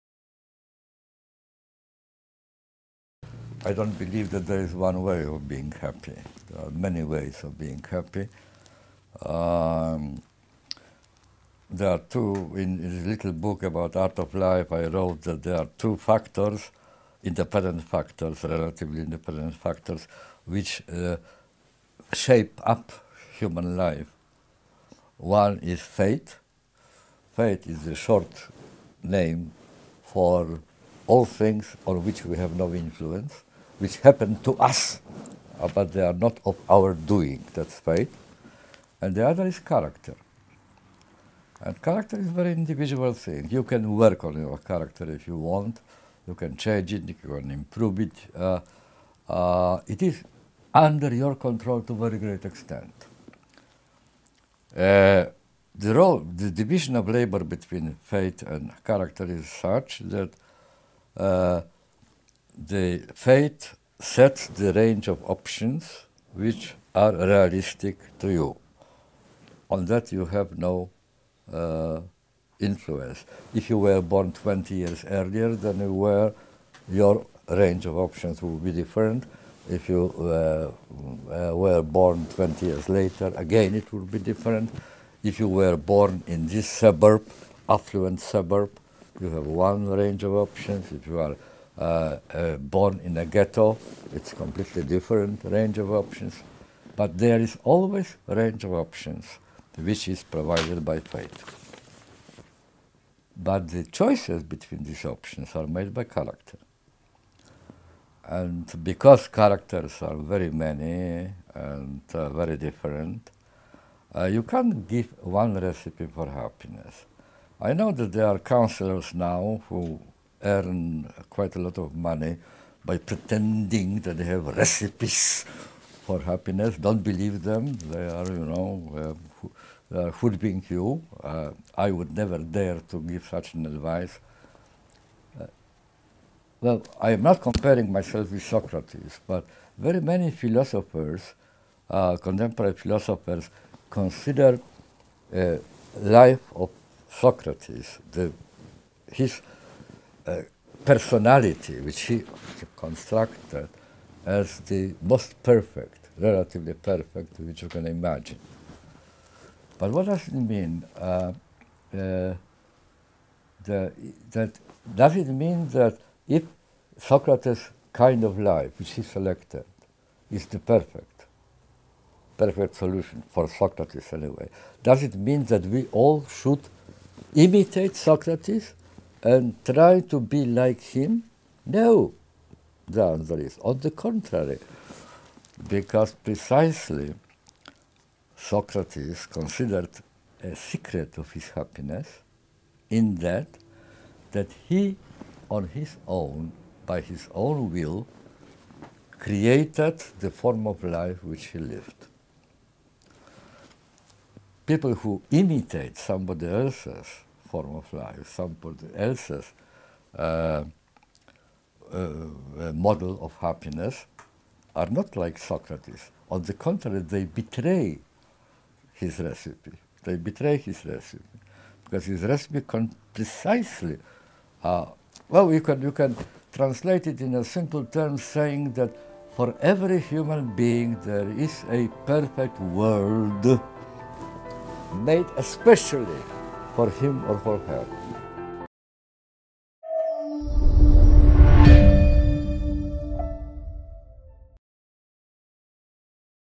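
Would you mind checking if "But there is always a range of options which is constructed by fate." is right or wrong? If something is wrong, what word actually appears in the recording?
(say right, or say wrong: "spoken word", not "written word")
wrong: "provided", not "constructed".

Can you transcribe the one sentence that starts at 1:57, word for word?
I know that there are counselors now who earn quite a lot of money by pretending that they have recipes for happiness.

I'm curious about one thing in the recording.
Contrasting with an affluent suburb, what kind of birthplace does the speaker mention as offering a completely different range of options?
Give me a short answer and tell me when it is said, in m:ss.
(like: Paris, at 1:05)
A ghetto, at 1:33.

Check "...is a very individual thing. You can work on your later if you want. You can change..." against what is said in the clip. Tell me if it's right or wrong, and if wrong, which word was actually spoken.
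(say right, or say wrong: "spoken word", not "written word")
wrong: "character", not "later".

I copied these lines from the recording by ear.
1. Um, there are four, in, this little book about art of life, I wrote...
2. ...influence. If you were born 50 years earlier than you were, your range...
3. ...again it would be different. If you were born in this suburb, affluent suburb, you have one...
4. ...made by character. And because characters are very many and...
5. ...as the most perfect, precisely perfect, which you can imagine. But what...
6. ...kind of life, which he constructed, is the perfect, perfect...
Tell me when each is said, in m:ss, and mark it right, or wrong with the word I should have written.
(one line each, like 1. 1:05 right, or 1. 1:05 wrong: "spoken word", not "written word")
1. 0:09 wrong: "two", not "four"
2. 1:12 wrong: "20", not "50"
3. 1:23 right
4. 1:45 right
5. 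2:34 wrong: "relatively", not "precisely"
6. 2:47 wrong: "selected", not "constructed".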